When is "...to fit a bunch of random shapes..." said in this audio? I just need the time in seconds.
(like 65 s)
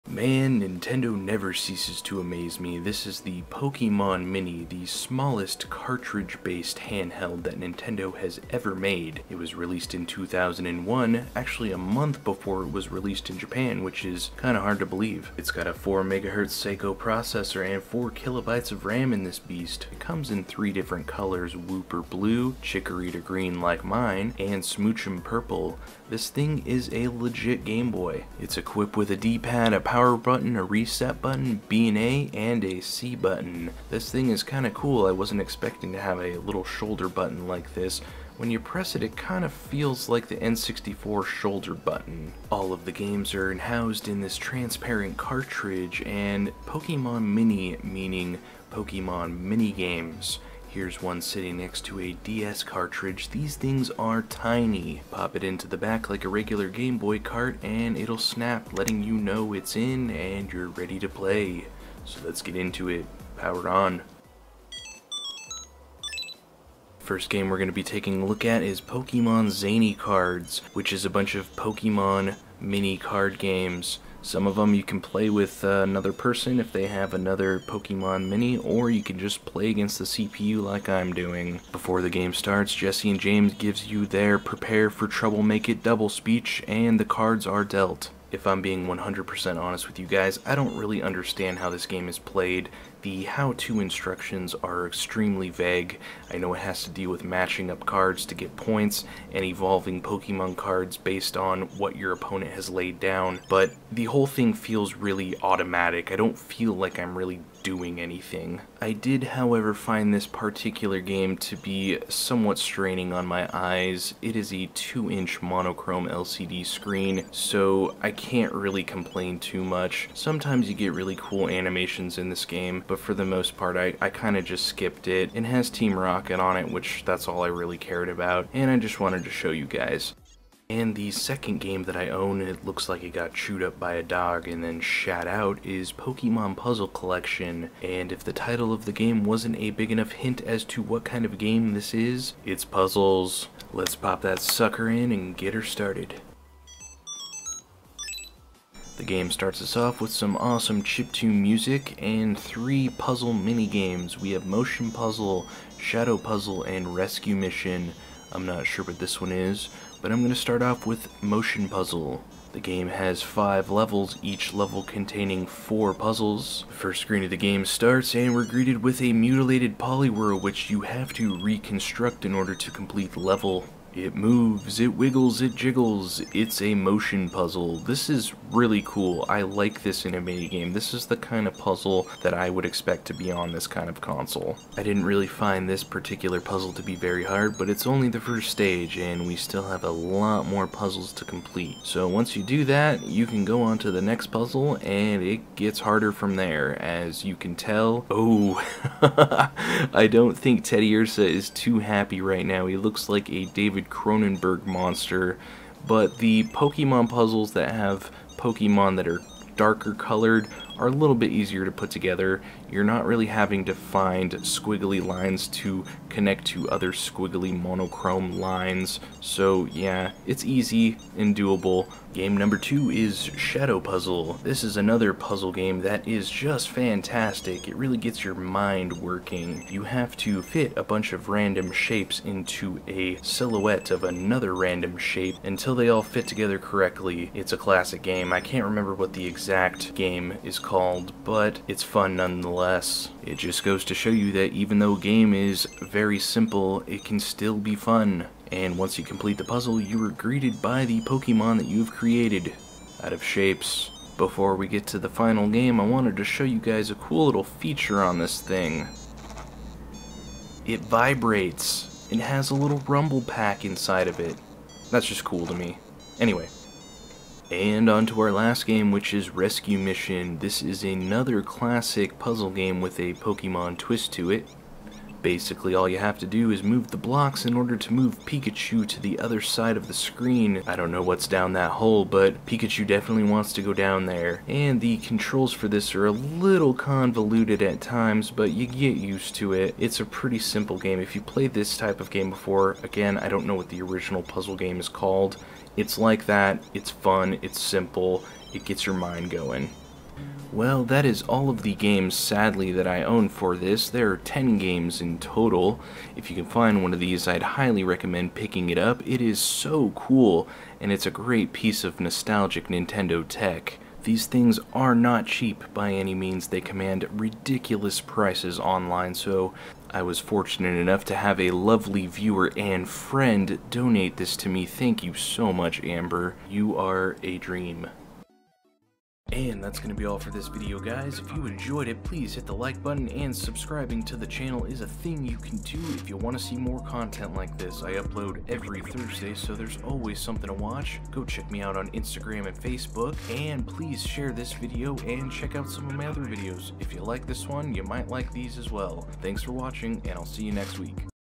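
230 s.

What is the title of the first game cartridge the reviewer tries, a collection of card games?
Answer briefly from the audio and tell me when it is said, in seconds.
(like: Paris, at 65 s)
Pokemon Zany Cards, at 68 s.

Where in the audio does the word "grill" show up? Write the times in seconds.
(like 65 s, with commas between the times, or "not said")
not said.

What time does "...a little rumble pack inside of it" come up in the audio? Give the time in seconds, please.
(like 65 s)
262 s.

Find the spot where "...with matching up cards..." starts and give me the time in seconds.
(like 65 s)
97 s.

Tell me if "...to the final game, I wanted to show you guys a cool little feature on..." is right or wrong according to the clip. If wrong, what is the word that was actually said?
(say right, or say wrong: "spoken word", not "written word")
right.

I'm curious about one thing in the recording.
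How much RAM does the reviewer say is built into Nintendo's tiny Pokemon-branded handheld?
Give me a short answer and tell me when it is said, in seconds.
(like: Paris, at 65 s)
4 kilobytes, at 17 s.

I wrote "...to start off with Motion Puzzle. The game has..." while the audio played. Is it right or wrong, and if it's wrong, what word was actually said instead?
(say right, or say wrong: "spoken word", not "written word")
right.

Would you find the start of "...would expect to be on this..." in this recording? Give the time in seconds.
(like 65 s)
182 s.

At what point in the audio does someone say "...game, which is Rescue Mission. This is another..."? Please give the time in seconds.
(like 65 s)
268 s.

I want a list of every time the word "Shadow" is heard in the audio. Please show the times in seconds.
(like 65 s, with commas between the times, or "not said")
155 s, 223 s.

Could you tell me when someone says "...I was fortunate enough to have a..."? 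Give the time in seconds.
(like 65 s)
319 s.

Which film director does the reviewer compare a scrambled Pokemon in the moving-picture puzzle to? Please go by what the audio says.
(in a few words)
David Cronenberg.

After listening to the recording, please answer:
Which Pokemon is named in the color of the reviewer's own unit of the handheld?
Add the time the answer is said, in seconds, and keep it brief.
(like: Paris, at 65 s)
Chikorita, at 22 s.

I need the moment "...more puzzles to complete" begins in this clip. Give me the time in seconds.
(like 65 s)
190 s.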